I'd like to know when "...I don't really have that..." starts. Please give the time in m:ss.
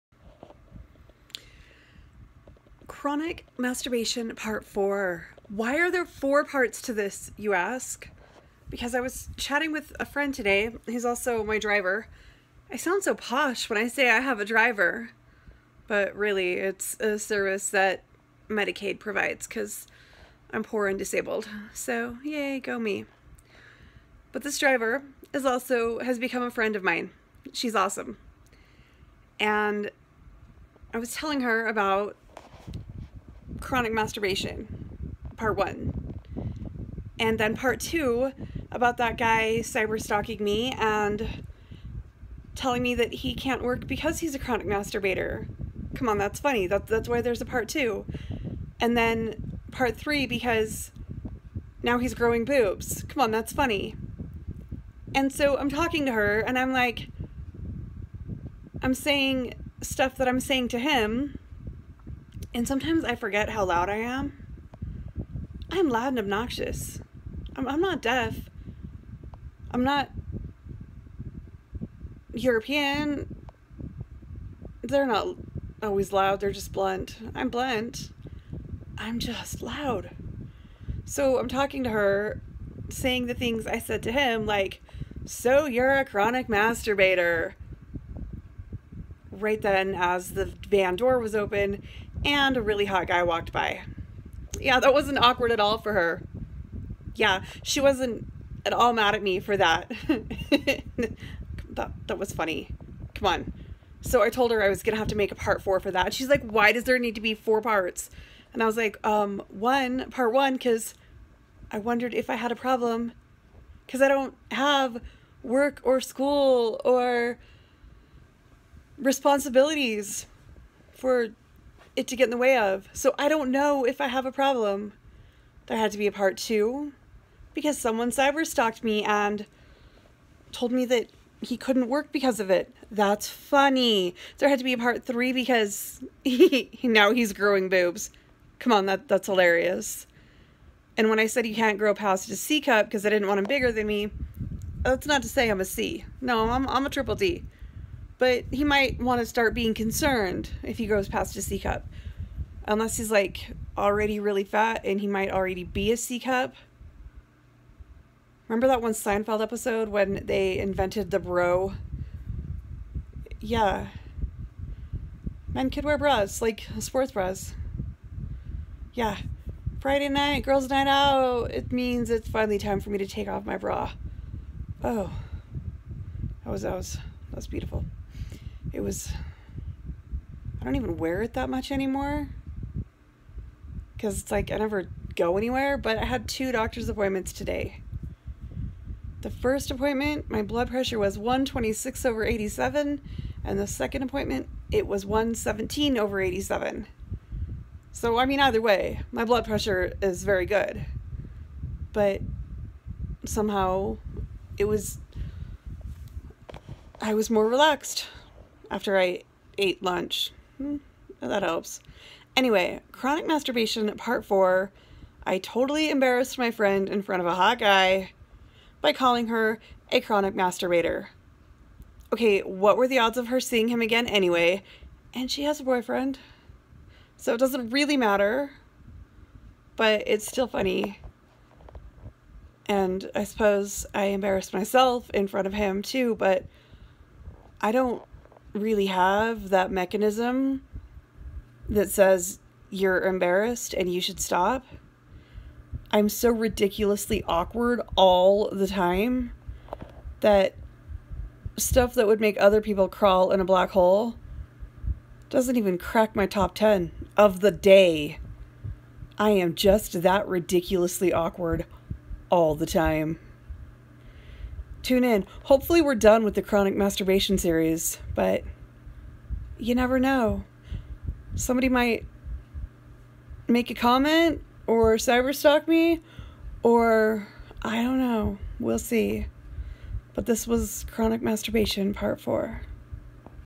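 3:57.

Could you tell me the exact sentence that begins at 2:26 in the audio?
No, I'm, I'm a triple D but he might want to start being concerned if he grows past a C cup.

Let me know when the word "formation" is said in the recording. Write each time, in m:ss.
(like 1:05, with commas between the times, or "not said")
not said.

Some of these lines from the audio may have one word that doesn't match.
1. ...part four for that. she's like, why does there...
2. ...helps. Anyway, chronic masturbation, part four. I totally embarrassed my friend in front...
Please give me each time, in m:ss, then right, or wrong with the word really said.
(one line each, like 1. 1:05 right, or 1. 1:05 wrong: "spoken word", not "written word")
1. 1:45 right
2. 3:31 right.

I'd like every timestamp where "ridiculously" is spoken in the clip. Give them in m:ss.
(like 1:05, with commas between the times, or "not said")
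4:06, 4:20.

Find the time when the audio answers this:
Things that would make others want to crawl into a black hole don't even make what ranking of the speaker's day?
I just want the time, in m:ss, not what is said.
4:16.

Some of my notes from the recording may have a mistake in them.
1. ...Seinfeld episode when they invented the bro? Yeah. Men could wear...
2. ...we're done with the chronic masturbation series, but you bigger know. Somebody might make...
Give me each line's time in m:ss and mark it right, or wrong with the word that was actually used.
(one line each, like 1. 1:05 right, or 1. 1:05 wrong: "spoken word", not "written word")
1. 2:38 right
2. 4:25 wrong: "never", not "bigger".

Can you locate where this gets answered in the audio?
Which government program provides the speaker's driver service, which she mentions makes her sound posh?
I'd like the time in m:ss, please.
0:18.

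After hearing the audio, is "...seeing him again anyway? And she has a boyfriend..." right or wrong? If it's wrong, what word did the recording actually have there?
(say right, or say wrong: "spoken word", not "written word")
right.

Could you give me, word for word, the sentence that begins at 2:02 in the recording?
So I don't know if I have a problem.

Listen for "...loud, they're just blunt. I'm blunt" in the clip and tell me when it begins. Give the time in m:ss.
1:16.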